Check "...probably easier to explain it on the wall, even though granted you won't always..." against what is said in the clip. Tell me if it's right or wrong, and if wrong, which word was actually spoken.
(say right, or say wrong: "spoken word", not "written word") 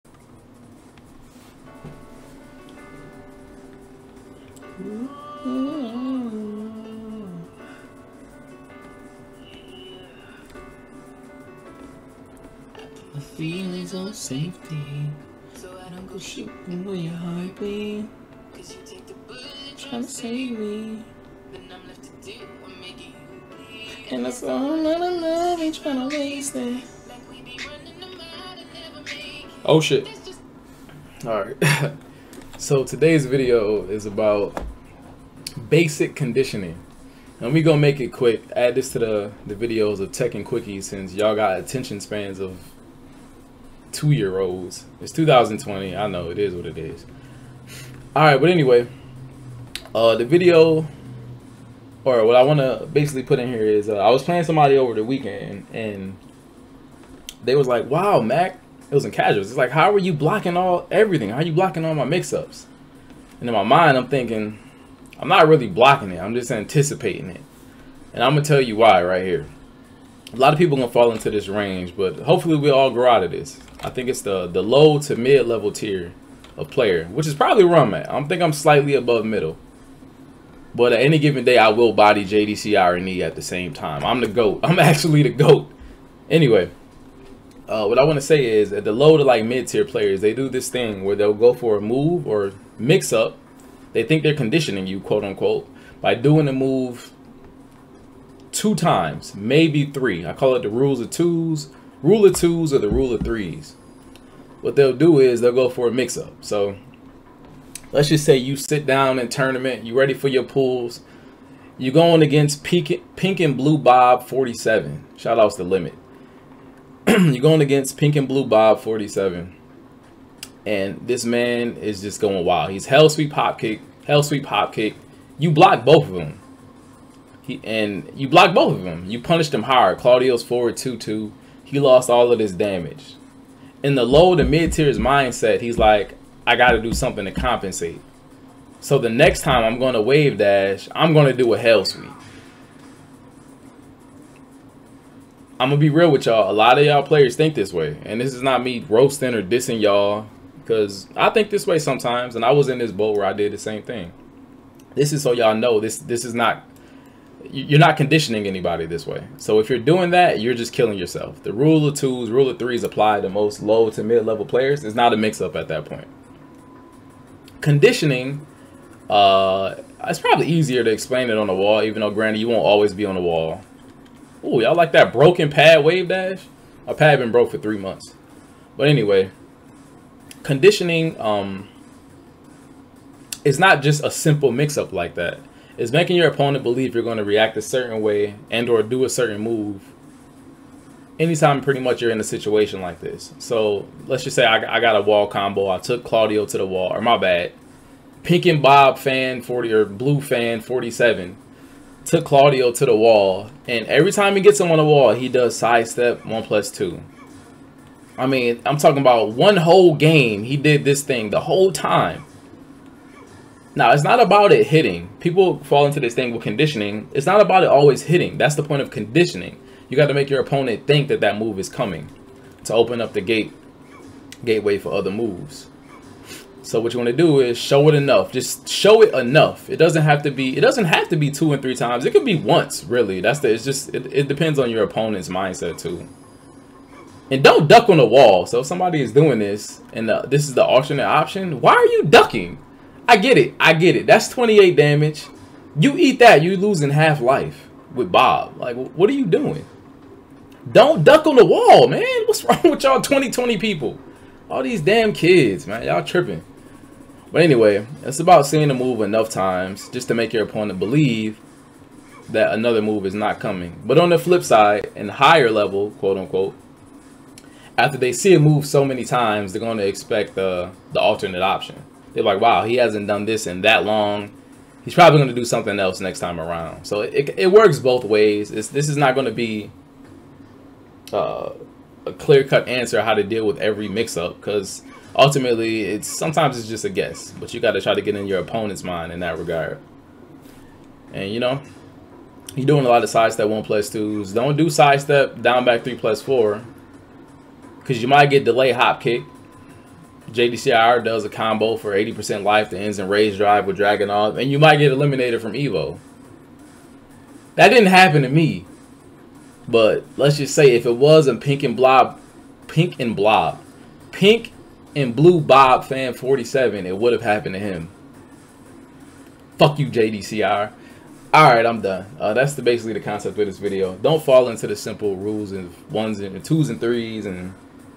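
right.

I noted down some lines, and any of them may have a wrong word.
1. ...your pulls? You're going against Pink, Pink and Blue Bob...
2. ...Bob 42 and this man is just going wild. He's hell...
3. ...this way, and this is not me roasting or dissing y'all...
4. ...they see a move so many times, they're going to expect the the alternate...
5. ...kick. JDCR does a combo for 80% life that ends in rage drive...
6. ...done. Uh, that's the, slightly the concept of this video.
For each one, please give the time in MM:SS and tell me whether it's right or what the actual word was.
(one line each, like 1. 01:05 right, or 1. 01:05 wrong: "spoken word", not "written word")
1. 01:50 right
2. 01:58 wrong: "47", not "42"
3. 02:27 right
4. 04:27 right
5. 04:59 right
6. 05:21 wrong: "basically", not "slightly".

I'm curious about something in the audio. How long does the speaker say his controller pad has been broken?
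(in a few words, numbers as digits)
3 months.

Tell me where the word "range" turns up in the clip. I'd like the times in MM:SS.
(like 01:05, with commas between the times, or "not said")
01:11.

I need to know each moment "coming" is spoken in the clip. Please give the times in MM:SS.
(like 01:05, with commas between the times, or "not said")
03:41, 04:23.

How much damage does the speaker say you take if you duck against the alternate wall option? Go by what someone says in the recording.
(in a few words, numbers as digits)
28.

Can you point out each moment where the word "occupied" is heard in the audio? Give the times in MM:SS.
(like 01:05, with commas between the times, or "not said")
not said.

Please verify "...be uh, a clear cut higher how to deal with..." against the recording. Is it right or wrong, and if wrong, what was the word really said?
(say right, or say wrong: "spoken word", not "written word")
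wrong: "answer", not "higher".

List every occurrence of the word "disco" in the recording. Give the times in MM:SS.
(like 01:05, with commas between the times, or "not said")
not said.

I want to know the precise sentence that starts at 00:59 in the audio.
It's like, "How are you blocking all everything?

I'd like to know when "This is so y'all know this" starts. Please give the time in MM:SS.
02:34.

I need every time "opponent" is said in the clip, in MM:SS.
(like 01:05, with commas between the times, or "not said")
03:06, 03:40, 03:54, 04:20, 04:48.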